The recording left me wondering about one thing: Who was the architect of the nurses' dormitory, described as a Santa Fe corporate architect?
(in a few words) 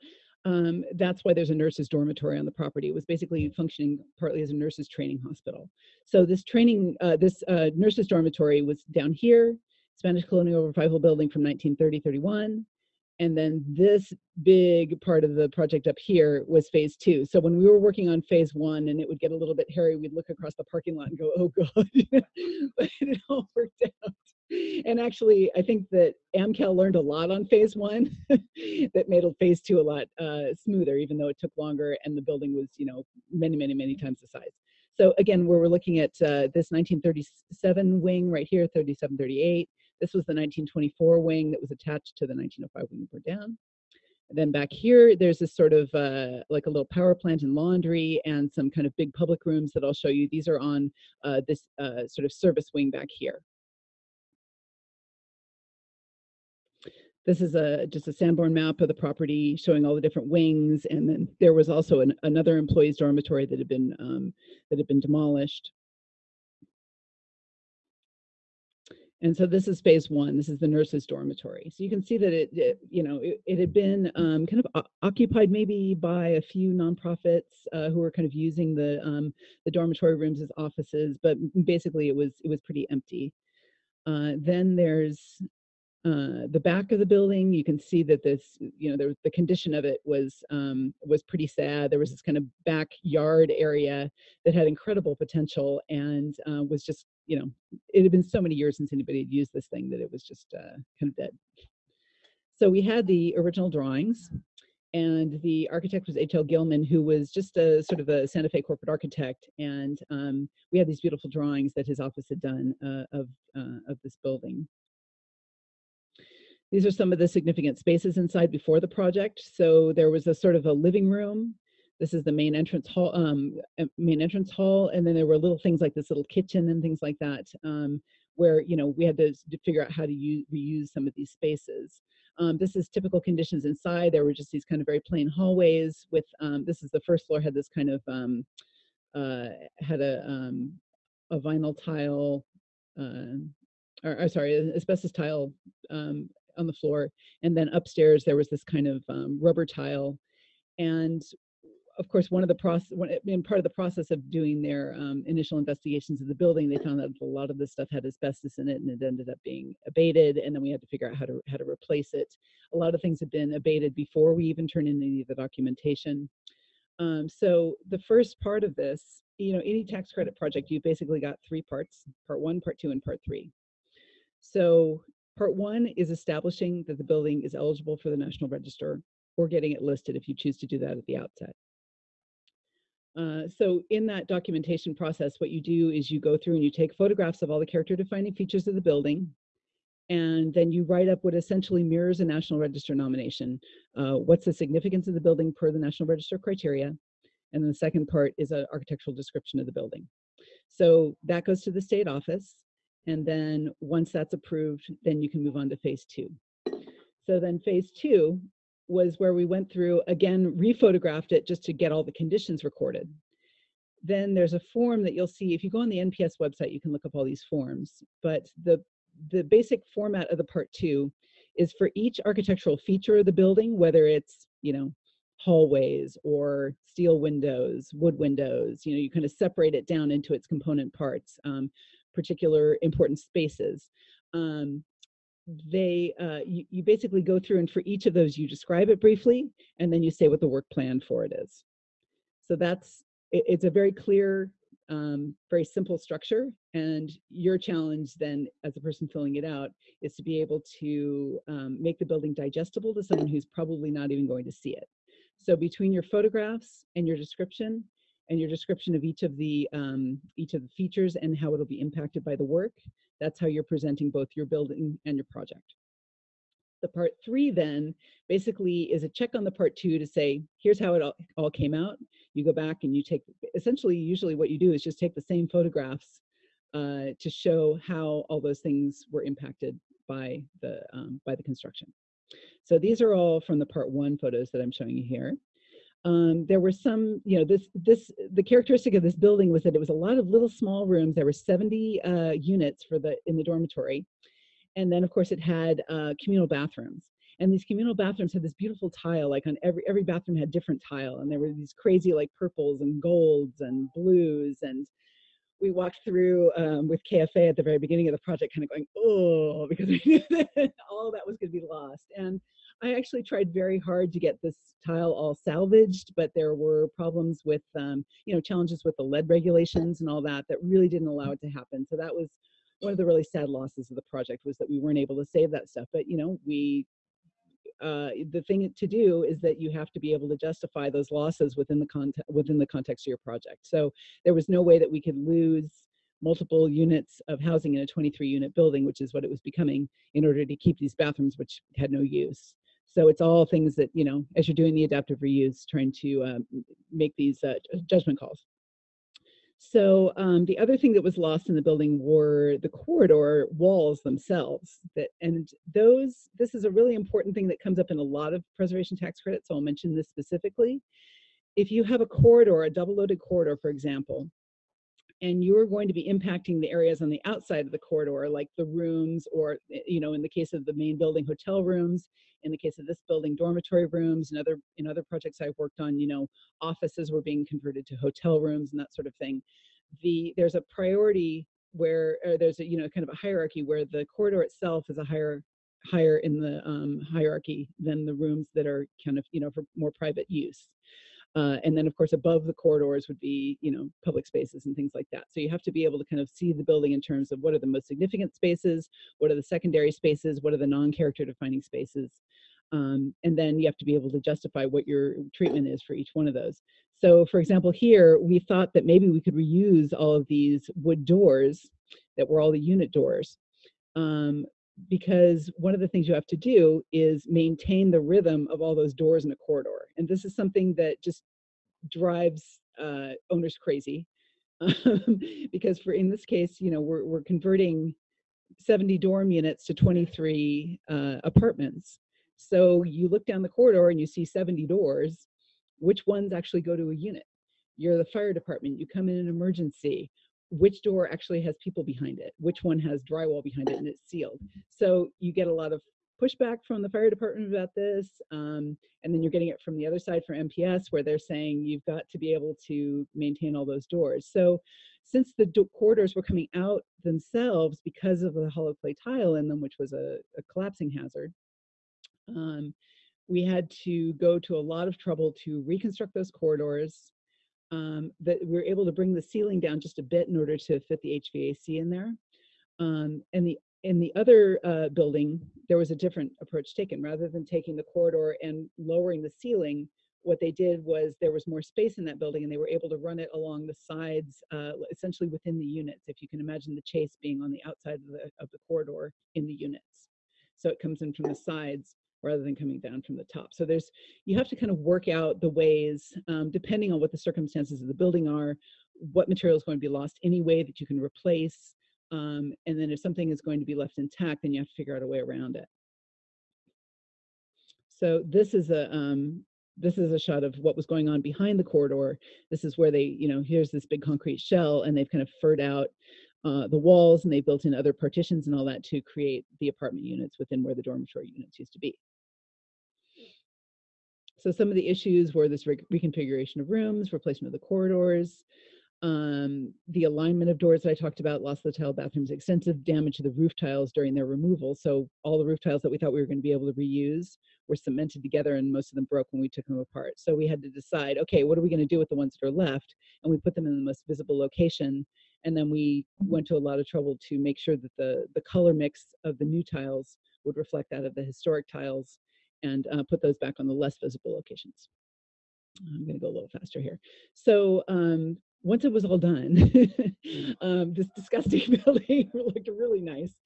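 H.L. Gilman.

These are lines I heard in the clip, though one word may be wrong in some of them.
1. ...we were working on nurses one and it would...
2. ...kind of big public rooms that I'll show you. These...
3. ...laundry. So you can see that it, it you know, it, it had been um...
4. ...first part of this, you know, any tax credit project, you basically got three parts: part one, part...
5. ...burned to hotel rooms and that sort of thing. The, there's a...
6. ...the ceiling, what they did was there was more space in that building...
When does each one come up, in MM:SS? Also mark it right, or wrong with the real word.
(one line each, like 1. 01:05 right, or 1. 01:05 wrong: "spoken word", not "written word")
1. 00:17 wrong: "phase", not "nurses"
2. 00:48 right
3. 01:11 wrong: "dormitory", not "laundry"
4. 02:47 right
5. 06:17 wrong: "converted", not "burned"
6. 07:59 right.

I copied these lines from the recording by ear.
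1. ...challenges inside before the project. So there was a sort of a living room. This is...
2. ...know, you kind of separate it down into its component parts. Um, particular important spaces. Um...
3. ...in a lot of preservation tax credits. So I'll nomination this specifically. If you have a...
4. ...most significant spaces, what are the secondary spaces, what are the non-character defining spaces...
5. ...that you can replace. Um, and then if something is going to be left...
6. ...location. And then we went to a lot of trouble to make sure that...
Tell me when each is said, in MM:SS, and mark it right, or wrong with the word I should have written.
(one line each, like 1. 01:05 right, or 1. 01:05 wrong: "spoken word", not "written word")
1. 01:57 wrong: "spaces", not "challenges"
2. 03:48 right
3. 05:57 wrong: "mention", not "nomination"
4. 06:37 right
5. 08:20 right
6. 09:04 right.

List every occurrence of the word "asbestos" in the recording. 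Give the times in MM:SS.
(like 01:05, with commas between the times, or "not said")
02:24, 02:38.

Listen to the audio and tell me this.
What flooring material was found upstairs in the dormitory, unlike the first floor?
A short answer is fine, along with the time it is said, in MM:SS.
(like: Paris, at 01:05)
rubber tile, at 02:29.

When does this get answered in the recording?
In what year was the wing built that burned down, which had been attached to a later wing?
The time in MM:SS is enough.
00:42.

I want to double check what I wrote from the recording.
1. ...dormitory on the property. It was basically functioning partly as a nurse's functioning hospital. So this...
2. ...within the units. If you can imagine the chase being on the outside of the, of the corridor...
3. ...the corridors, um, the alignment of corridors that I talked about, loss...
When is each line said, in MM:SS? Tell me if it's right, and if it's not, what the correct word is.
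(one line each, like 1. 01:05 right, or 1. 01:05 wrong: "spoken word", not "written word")
1. 00:01 wrong: "training", not "functioning"
2. 08:05 right
3. 08:47 wrong: "doors", not "corridors".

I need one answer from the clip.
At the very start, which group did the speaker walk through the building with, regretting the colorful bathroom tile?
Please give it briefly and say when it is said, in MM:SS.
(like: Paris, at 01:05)
KFA, at 05:07.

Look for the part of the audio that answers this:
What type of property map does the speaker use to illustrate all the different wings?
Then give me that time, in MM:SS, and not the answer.
00:58.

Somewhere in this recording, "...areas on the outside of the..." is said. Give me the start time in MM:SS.
06:06.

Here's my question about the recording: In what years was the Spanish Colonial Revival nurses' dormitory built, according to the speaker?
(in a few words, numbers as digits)
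1930-31.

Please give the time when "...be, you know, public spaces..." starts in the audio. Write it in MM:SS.
06:33.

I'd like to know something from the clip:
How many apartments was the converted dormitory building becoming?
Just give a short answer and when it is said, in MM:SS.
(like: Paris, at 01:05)
23, at 05:37.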